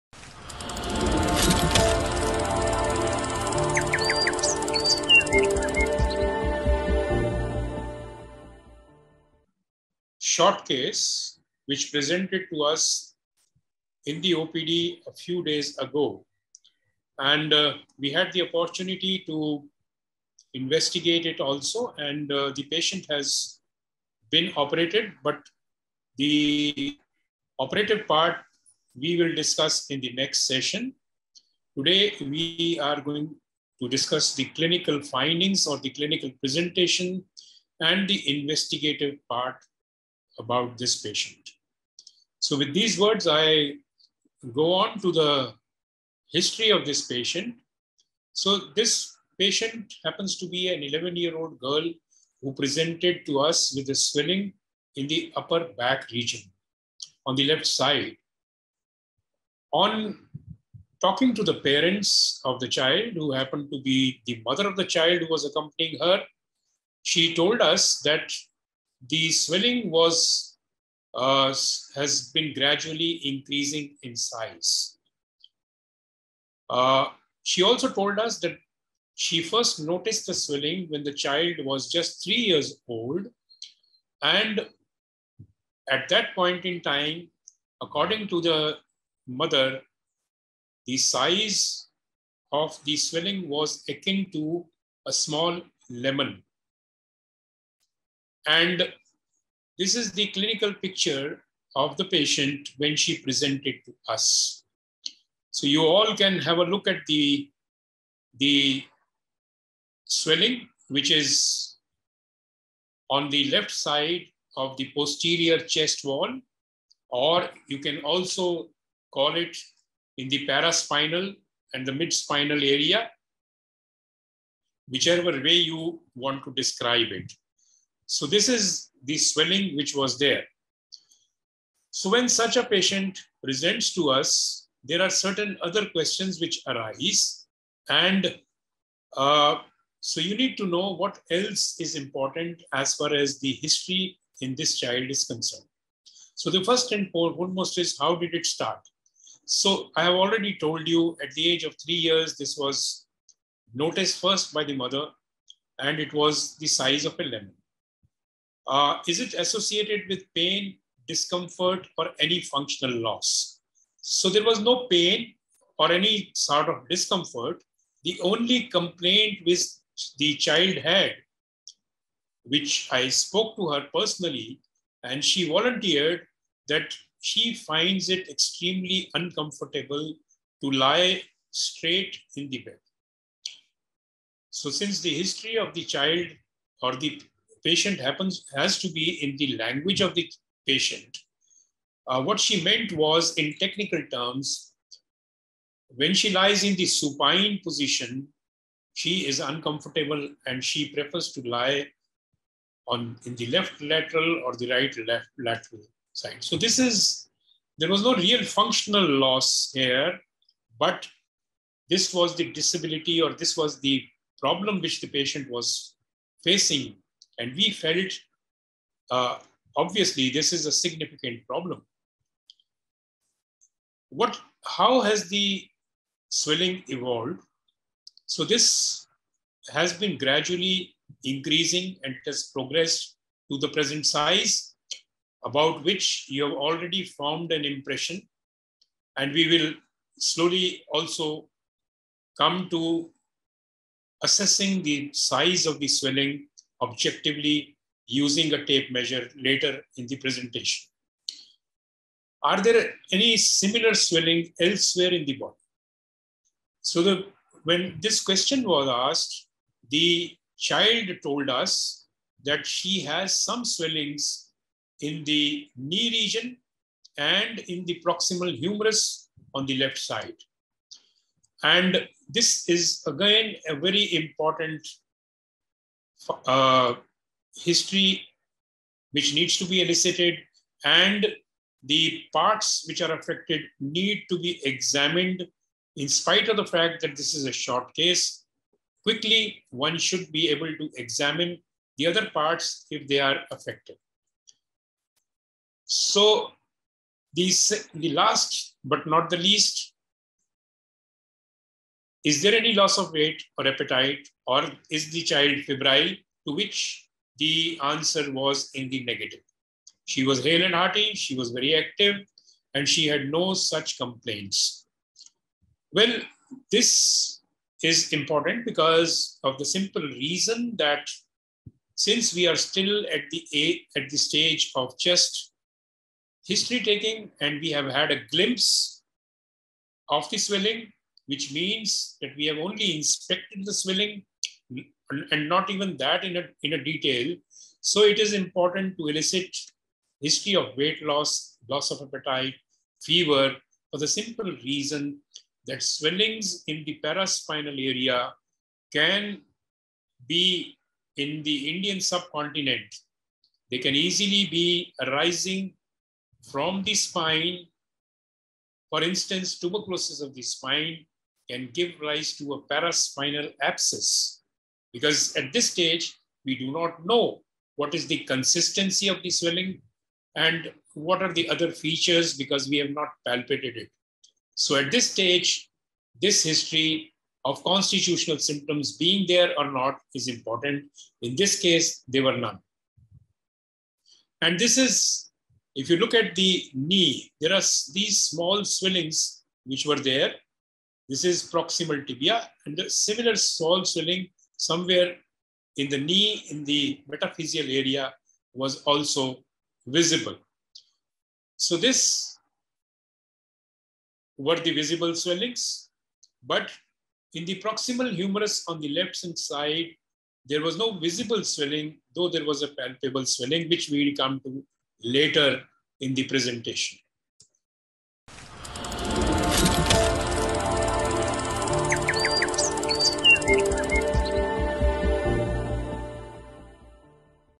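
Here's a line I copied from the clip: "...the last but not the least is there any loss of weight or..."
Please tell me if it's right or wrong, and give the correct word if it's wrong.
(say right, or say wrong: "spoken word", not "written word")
right.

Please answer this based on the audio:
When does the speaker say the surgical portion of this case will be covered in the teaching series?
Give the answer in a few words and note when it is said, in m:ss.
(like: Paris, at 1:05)
next session, at 0:30.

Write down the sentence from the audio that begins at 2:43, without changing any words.
So there was no pain or any sort of discomfort.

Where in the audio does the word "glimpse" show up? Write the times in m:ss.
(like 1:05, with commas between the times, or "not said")
5:28.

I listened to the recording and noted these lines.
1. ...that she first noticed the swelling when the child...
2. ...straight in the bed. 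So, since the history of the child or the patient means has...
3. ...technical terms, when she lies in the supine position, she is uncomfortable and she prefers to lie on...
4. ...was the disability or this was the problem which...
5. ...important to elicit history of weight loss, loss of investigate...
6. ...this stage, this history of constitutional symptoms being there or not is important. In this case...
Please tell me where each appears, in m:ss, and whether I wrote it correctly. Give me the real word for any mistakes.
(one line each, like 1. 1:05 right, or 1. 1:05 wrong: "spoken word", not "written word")
1. 1:18 right
2. 3:01 wrong: "happens", not "means"
3. 3:13 right
4. 3:32 right
5. 5:38 wrong: "appetite", not "investigate"
6. 6:14 right.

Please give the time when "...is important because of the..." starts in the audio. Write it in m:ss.
5:17.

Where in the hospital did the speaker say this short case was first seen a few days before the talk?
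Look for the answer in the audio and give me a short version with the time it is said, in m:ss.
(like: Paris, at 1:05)
OPD, at 0:14.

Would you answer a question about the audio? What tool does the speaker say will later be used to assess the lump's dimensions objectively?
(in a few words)
tape measure.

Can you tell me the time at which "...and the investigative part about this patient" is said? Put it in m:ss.
0:37.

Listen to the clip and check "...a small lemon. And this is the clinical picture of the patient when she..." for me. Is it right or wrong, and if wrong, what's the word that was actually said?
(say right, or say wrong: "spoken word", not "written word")
right.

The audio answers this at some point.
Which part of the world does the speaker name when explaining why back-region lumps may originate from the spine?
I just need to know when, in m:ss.
5:51.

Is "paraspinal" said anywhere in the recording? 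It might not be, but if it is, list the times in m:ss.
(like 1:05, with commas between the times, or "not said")
2:00, 5:47, 6:02.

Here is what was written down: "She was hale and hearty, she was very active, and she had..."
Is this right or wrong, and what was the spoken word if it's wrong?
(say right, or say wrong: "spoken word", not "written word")
right.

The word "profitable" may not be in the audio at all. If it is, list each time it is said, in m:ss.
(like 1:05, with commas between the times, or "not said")
not said.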